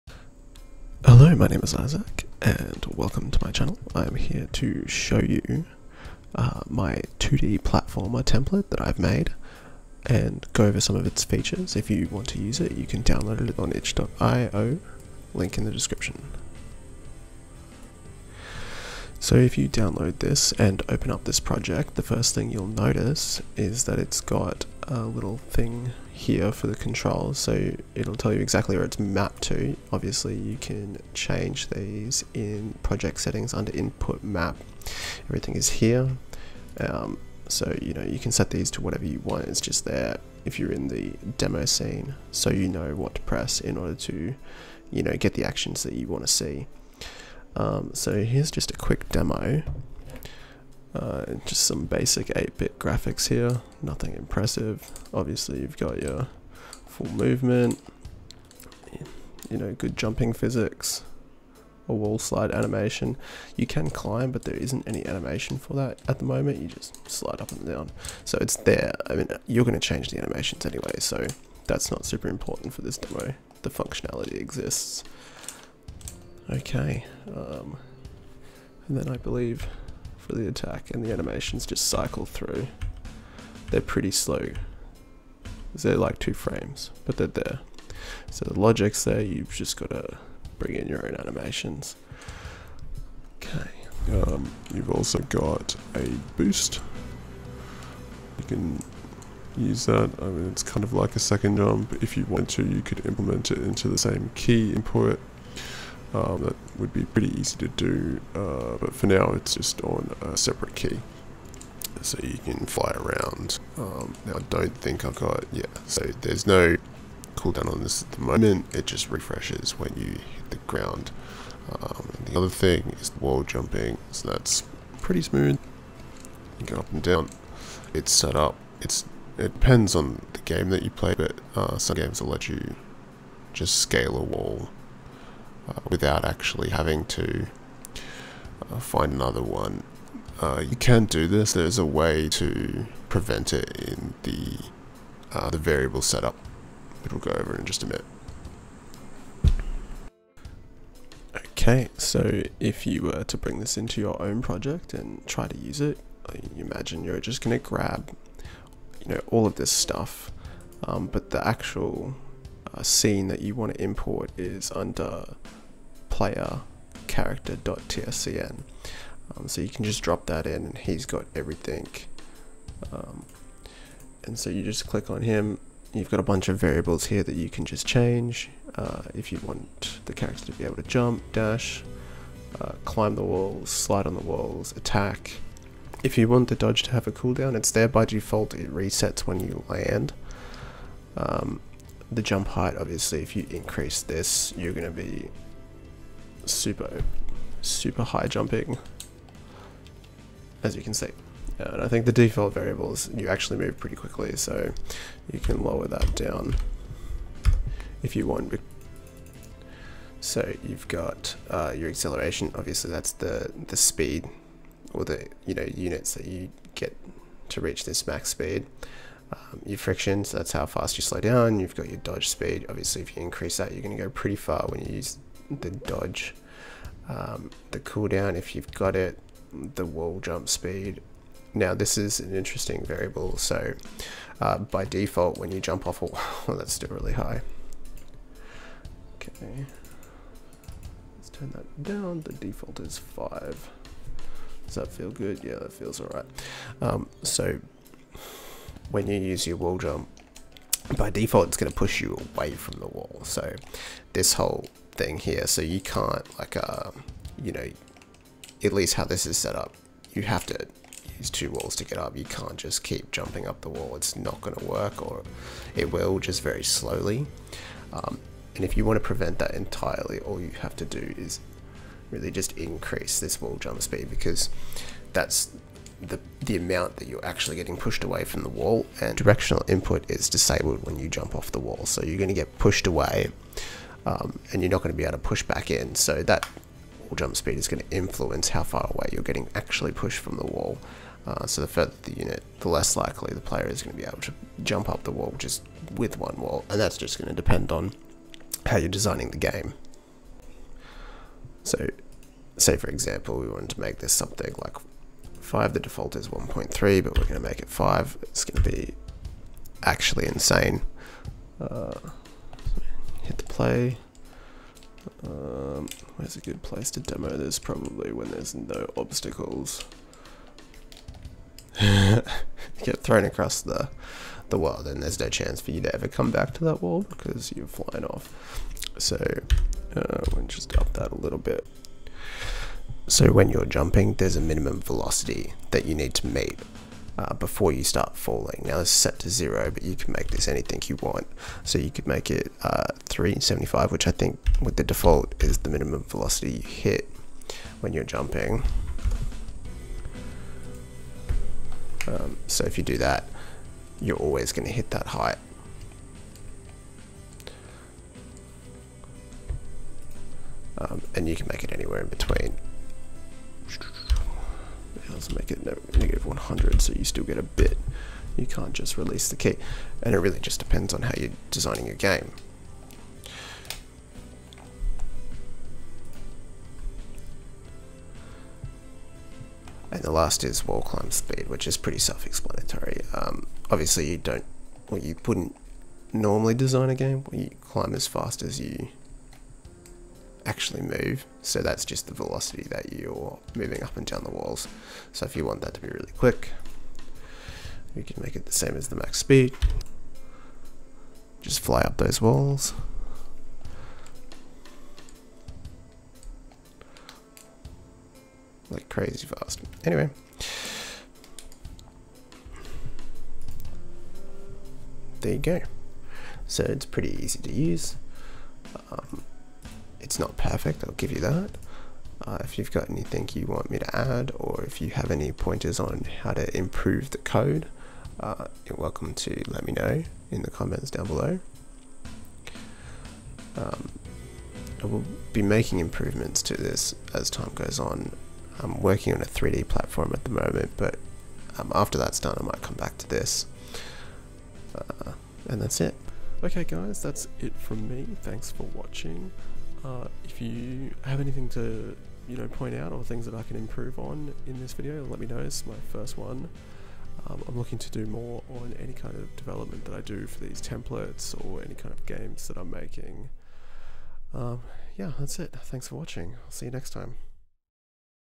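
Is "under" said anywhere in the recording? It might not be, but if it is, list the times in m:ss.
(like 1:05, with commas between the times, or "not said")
0:33, 2:44.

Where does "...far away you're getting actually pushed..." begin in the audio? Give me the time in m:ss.
4:48.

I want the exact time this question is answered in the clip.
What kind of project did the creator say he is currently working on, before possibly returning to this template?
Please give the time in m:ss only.
7:19.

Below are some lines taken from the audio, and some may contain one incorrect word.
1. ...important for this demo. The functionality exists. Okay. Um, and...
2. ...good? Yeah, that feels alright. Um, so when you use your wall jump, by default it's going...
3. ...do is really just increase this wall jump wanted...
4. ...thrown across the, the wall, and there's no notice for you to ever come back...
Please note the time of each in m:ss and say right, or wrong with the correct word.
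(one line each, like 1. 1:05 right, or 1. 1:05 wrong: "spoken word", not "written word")
1. 1:12 right
2. 4:05 right
3. 4:30 wrong: "speed", not "wanted"
4. 5:22 wrong: "chance", not "notice".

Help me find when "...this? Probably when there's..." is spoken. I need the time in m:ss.
5:17.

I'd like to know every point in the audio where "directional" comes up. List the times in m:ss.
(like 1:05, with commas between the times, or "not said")
4:39.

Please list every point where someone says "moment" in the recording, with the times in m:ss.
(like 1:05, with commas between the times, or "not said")
1:06, 1:58, 7:20.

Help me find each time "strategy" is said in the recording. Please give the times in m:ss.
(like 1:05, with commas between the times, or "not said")
not said.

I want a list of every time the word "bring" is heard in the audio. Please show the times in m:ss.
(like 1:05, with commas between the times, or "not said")
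1:30, 2:33.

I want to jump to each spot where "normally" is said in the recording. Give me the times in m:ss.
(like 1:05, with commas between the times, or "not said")
6:26.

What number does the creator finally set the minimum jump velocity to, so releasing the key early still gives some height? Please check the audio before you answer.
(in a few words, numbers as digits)
-100.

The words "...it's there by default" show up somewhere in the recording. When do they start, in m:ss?
3:07.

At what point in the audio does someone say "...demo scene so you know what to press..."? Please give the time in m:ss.
0:41.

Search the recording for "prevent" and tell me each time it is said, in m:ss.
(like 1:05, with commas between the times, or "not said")
2:23, 4:29.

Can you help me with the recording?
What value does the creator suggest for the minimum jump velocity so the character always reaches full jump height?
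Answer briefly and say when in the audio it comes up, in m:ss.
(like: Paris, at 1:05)
375, at 5:43.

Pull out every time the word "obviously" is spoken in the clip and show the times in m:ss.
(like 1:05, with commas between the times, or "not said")
0:29, 0:55, 3:12, 3:32, 3:42, 6:23.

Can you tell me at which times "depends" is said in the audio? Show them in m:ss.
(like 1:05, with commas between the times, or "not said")
2:09, 4:57, 6:10.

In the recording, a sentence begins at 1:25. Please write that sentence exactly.
They're like two frames, but they're there.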